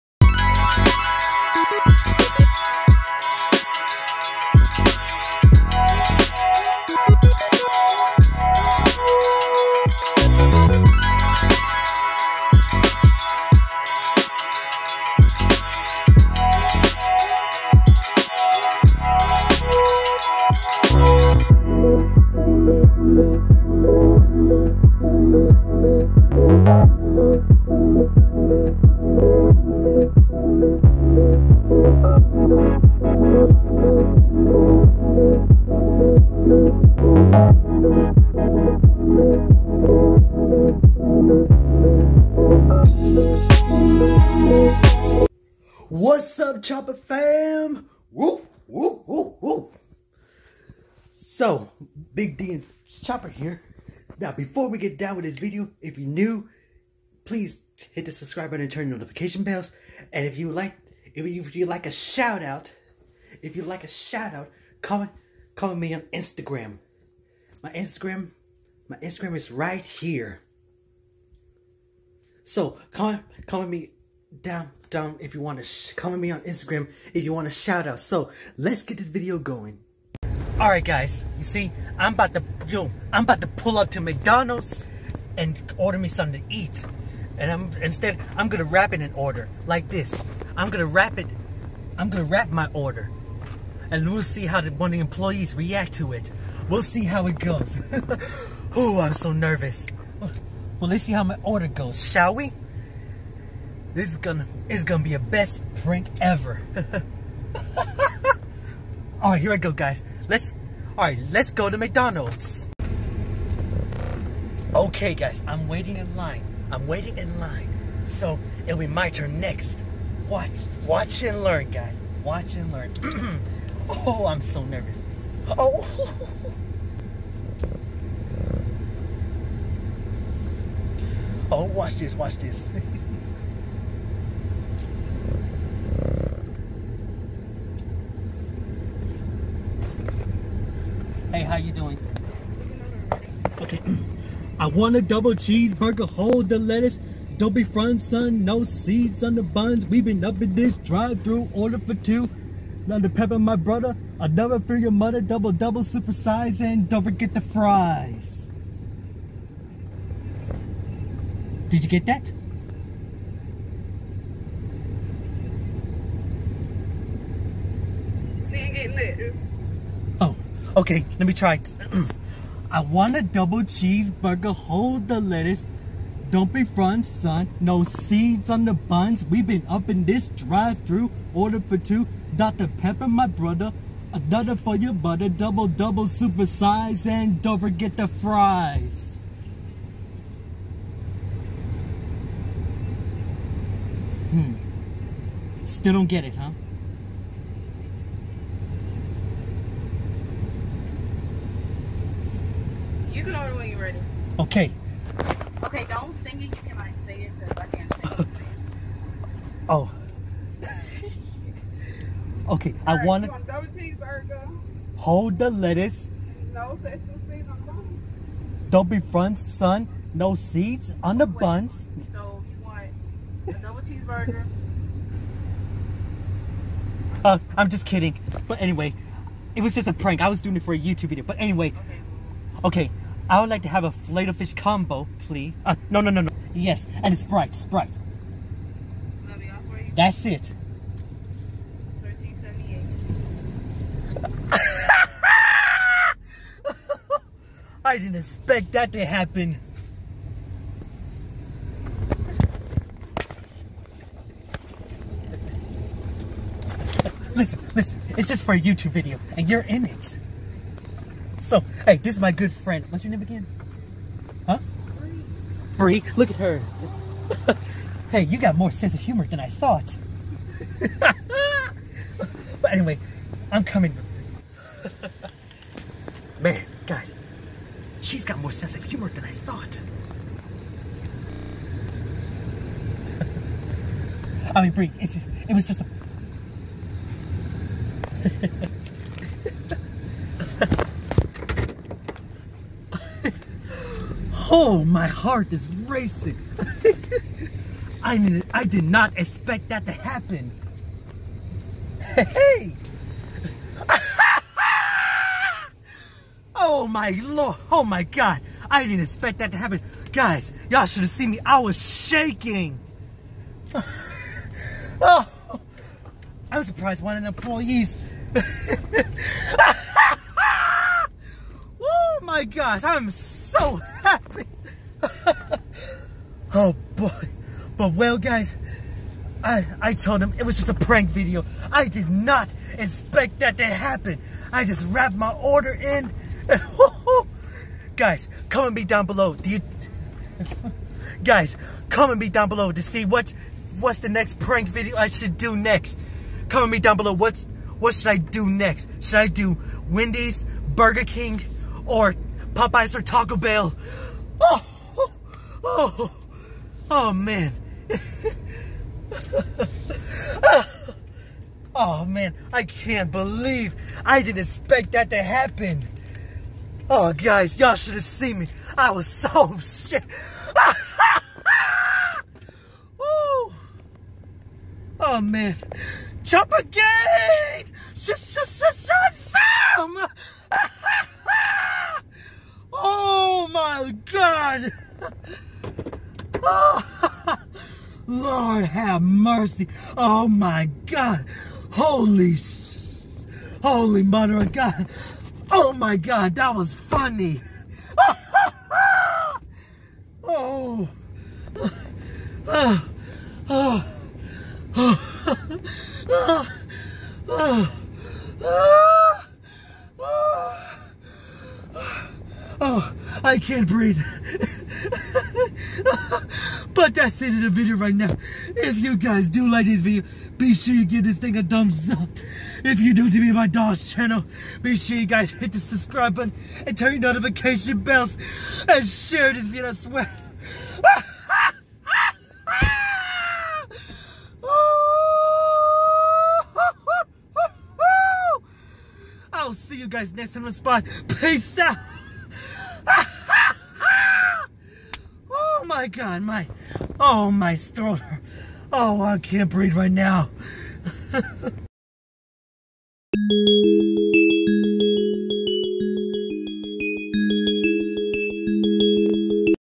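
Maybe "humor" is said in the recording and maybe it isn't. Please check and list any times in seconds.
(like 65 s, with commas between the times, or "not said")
268 s, 278 s.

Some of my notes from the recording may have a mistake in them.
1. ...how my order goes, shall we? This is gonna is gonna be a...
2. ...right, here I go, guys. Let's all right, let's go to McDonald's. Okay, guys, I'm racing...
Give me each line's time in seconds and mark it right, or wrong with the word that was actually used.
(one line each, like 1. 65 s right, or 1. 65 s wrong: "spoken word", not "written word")
1. 101 s right
2. 109 s wrong: "waiting", not "racing".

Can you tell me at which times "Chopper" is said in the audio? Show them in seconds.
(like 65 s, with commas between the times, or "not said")
46 s, 53 s.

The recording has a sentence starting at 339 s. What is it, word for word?
Do you, guys, comment me down below to see what what's the next prank video I should do next.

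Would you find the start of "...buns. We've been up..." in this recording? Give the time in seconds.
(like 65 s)
178 s.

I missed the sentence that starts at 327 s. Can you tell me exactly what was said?
But well guys, I, I told him it was just a prank video.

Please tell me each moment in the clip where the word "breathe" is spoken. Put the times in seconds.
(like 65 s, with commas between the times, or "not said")
413 s, 449 s.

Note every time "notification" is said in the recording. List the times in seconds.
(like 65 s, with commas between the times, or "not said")
58 s, 427 s.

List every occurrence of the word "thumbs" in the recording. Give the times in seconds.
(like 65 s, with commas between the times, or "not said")
421 s.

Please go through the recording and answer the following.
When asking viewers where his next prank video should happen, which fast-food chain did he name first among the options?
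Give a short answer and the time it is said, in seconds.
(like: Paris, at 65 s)
Wendy's, at 349 s.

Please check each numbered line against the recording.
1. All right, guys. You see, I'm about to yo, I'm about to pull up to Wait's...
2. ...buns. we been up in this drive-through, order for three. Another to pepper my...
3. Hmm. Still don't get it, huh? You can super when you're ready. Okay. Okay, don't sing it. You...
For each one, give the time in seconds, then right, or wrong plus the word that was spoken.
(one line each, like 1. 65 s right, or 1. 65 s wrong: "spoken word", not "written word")
1. 80 s wrong: "McDonald", not "Wait"
2. 149 s wrong: "two", not "three"
3. 194 s wrong: "order", not "super".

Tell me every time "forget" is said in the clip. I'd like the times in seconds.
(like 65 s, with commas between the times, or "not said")
157 s, 187 s.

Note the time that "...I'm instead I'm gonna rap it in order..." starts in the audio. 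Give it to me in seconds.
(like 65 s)
87 s.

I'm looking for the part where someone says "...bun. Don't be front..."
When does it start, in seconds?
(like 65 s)
217 s.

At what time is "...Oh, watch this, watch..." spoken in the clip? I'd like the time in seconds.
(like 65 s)
131 s.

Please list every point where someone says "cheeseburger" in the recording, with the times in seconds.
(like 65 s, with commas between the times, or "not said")
145 s, 173 s.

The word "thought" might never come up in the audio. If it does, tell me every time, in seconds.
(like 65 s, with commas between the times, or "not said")
269 s, 279 s.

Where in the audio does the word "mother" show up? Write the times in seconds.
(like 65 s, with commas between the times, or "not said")
154 s, 394 s.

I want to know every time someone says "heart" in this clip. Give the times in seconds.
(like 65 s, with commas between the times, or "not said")
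295 s.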